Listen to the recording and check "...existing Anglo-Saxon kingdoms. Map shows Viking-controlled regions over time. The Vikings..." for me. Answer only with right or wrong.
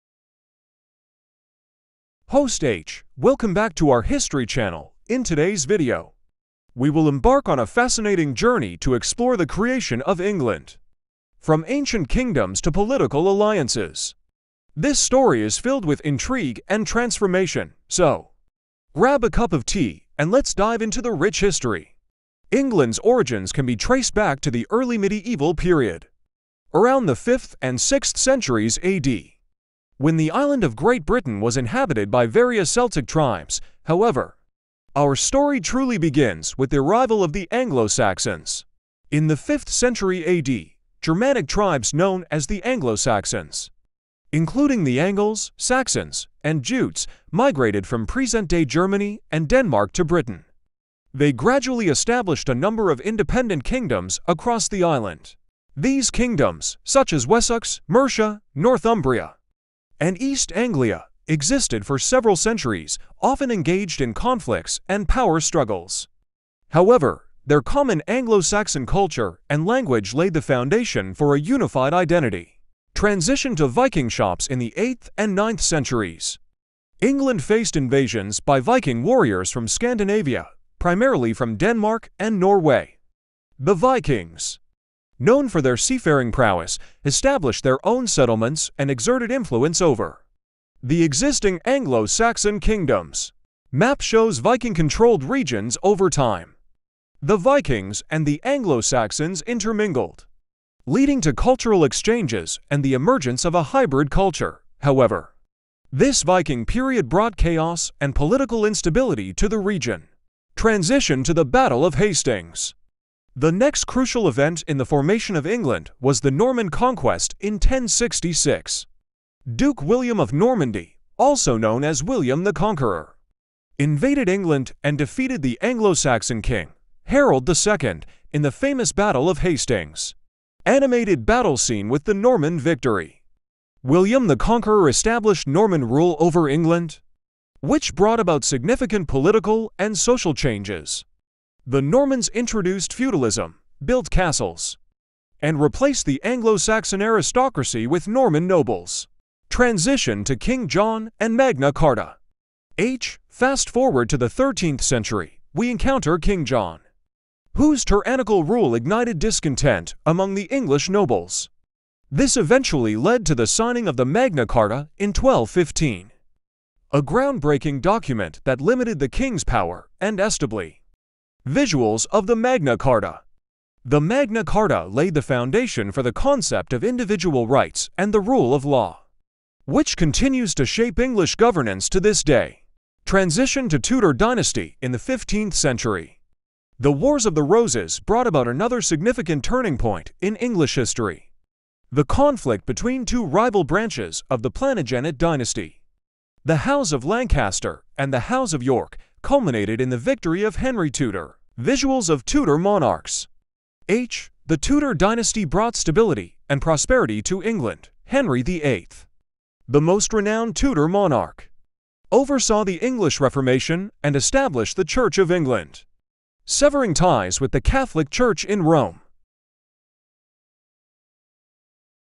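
right.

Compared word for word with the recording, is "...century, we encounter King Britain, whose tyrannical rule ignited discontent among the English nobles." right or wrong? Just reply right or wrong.
wrong.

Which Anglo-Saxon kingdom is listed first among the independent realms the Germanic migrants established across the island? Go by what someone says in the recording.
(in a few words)
Wessex.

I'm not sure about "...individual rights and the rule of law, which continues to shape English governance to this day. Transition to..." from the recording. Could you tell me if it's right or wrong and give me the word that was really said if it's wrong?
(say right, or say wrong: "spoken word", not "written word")
right.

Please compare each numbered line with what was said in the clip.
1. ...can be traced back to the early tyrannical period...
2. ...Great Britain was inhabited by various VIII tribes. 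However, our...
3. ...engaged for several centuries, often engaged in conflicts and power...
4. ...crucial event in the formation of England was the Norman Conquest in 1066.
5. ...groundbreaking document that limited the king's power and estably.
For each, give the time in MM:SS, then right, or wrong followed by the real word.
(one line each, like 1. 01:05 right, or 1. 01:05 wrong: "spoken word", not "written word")
1. 00:23 wrong: "medieval", not "tyrannical"
2. 00:30 wrong: "Celtic", not "VIII"
3. 01:01 wrong: "existed", not "engaged"
4. 01:53 right
5. 02:47 right.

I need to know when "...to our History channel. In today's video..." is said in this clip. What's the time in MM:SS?
00:03.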